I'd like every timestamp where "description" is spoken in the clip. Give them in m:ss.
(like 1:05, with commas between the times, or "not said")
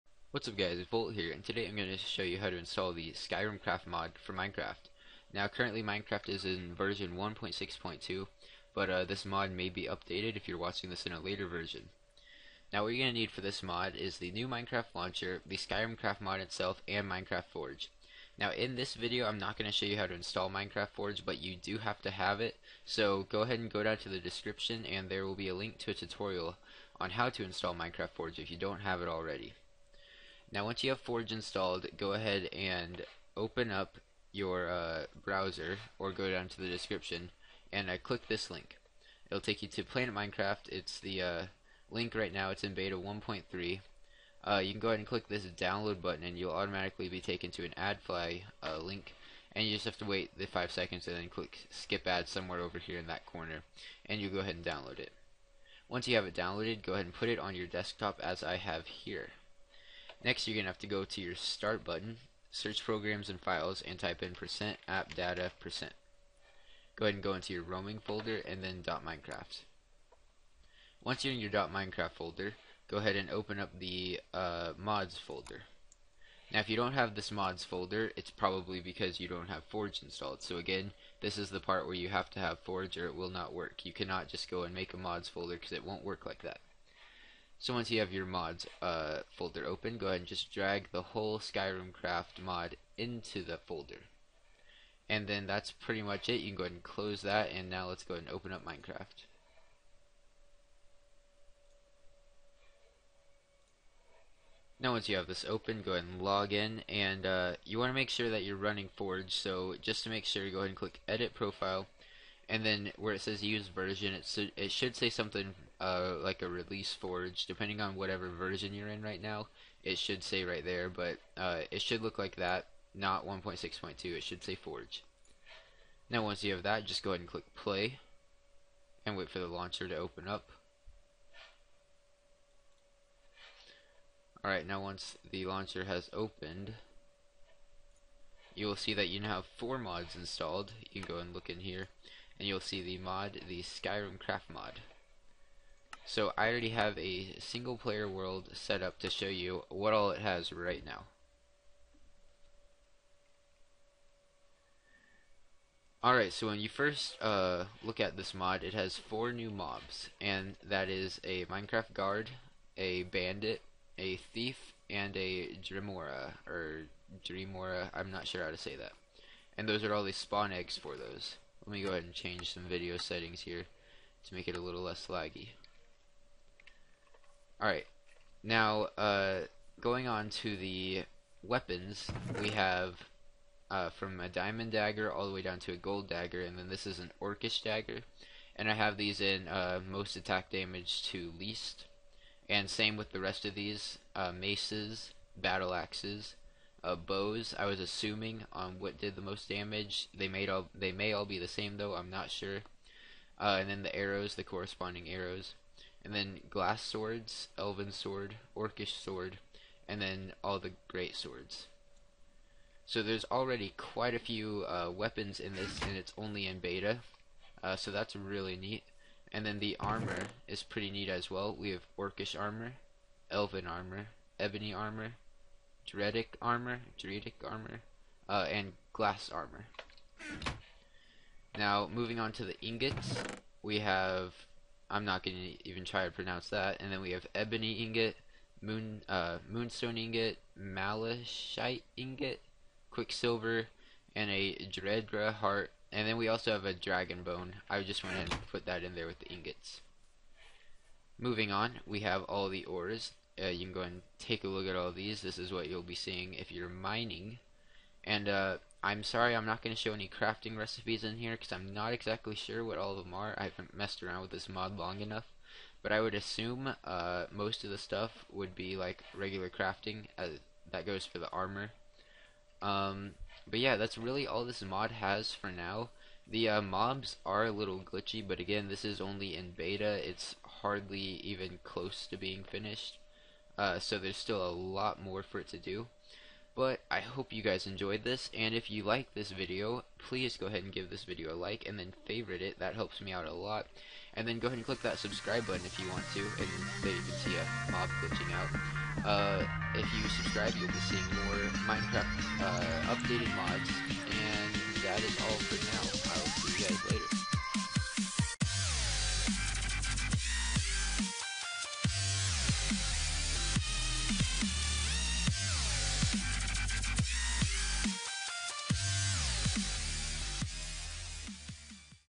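0:24, 0:36.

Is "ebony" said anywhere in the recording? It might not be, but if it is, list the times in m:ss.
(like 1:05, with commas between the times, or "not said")
3:44, 3:57.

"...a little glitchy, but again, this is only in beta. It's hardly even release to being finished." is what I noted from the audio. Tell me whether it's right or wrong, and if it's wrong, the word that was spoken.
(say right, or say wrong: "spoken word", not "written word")
wrong: "close", not "release".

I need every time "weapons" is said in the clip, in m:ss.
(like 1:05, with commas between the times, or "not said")
3:01, 3:34.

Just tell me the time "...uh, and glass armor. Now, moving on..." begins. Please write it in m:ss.
3:48.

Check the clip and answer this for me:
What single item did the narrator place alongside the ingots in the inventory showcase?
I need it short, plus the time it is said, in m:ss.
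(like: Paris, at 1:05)
dragon bone, at 4:06.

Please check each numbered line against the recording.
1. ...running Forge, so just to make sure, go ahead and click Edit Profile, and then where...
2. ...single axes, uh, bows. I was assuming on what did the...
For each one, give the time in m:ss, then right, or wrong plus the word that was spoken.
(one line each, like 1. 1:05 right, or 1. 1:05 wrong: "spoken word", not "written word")
1. 1:48 right
2. 3:15 wrong: "battle", not "single".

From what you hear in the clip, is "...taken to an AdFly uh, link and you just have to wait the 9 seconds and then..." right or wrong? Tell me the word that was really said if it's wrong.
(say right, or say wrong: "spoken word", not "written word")
wrong: "5", not "9".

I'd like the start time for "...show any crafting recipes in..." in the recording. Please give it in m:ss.
4:19.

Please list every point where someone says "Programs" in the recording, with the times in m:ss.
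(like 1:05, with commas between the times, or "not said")
1:02.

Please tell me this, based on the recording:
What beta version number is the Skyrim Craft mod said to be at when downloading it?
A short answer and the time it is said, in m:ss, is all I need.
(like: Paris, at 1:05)
beta 1.3, at 0:42.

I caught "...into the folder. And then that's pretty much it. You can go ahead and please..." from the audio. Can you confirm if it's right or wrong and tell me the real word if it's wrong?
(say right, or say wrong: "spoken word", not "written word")
wrong: "close", not "please".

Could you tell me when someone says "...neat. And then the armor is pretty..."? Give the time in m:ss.
3:38.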